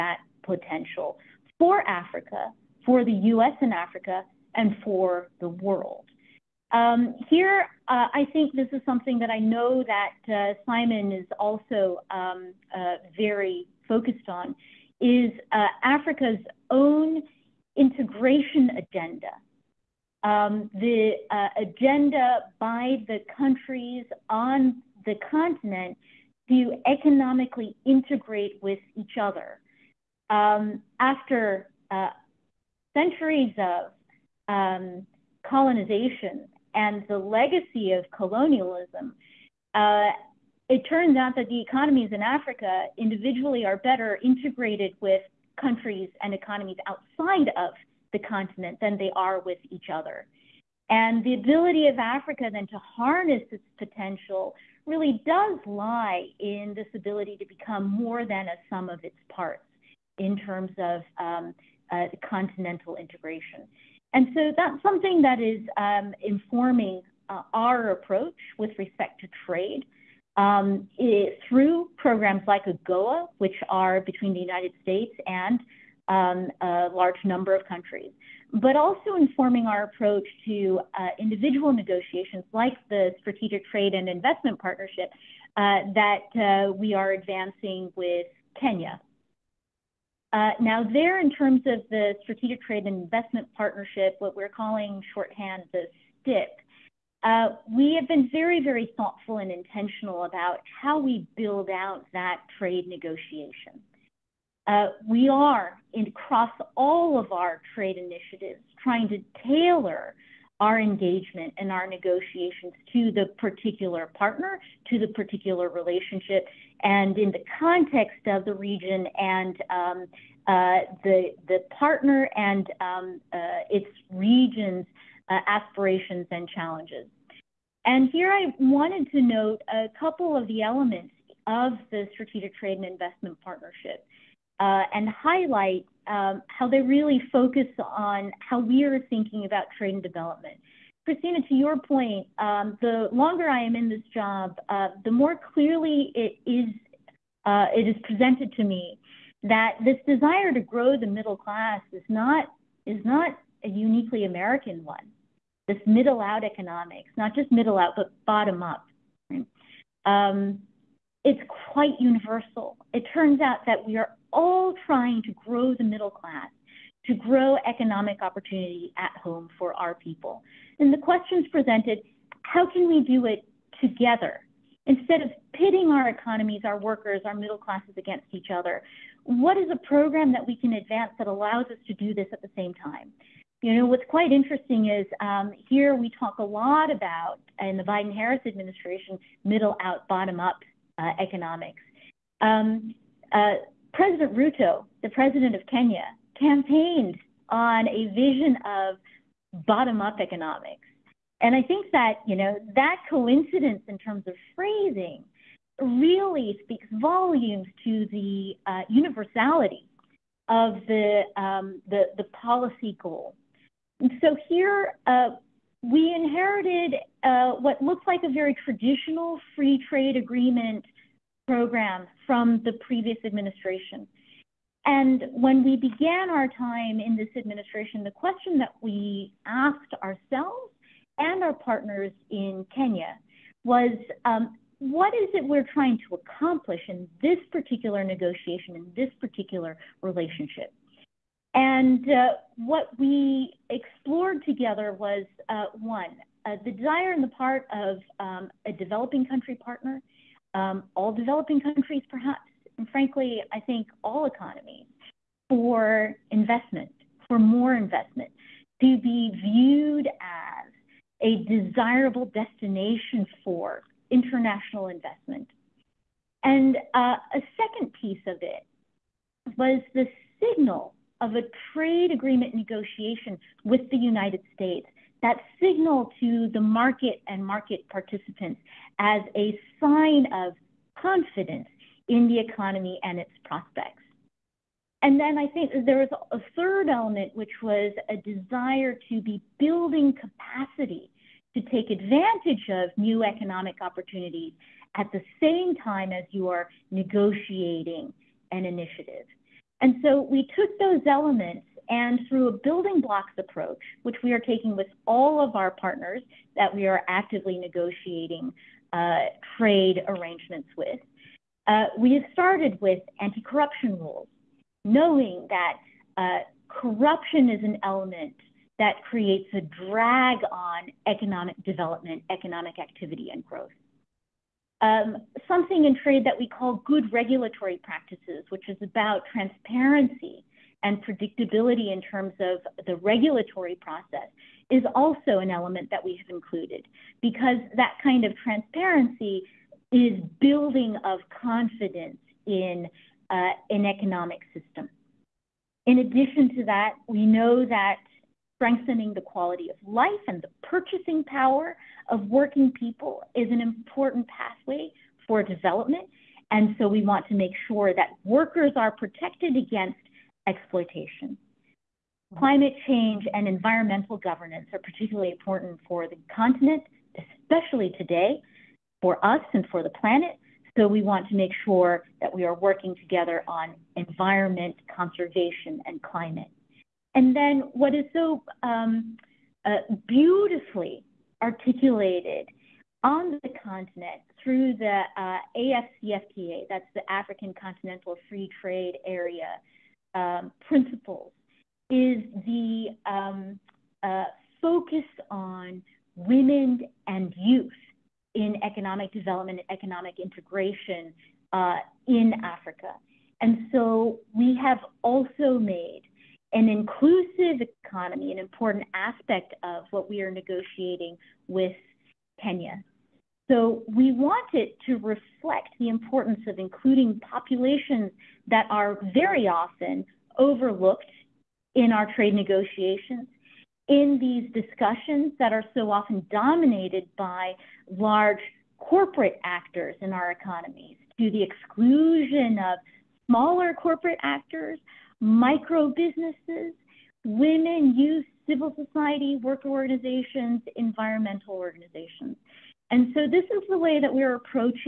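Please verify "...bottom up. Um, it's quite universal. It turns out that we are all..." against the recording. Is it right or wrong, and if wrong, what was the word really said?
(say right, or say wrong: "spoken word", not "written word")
right.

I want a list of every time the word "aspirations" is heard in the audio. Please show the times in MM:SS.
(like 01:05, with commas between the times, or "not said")
02:05.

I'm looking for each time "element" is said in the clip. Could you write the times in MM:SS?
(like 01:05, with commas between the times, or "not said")
02:10, 04:46, 05:01, 05:17, 05:35.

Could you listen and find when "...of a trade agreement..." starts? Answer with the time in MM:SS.
04:31.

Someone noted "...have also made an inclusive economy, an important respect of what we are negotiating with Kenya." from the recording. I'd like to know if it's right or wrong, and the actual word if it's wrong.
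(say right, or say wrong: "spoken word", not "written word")
wrong: "aspect", not "respect".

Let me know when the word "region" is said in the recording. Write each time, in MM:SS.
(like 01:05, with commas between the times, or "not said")
01:58, 02:04.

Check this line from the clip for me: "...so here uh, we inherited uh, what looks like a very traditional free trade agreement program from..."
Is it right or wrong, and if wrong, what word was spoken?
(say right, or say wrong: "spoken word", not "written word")
right.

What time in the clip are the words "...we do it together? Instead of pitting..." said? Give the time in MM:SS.
02:52.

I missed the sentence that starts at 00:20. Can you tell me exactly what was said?
Um, the uh, agenda by the countries on the continent to economically integrate with each other.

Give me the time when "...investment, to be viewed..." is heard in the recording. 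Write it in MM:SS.
04:17.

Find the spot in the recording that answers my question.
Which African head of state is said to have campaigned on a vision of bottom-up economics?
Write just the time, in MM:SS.
03:13.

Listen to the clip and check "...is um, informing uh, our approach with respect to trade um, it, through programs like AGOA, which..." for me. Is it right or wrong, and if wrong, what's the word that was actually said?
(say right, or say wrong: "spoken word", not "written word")
right.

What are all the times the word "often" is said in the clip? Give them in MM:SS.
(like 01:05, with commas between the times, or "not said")
06:59, 07:05.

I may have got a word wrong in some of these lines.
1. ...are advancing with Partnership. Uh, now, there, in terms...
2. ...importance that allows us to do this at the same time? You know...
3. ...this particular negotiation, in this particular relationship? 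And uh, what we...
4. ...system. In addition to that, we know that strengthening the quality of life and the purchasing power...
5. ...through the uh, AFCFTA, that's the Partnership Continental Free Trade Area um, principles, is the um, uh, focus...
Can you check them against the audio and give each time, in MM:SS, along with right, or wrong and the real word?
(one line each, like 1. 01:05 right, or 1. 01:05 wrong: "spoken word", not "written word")
1. 01:26 wrong: "Kenya", not "Partnership"
2. 03:00 wrong: "advance", not "importance"
3. 03:57 right
4. 05:44 right
5. 06:24 wrong: "African", not "Partnership".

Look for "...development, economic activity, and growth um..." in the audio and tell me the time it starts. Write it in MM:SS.
05:21.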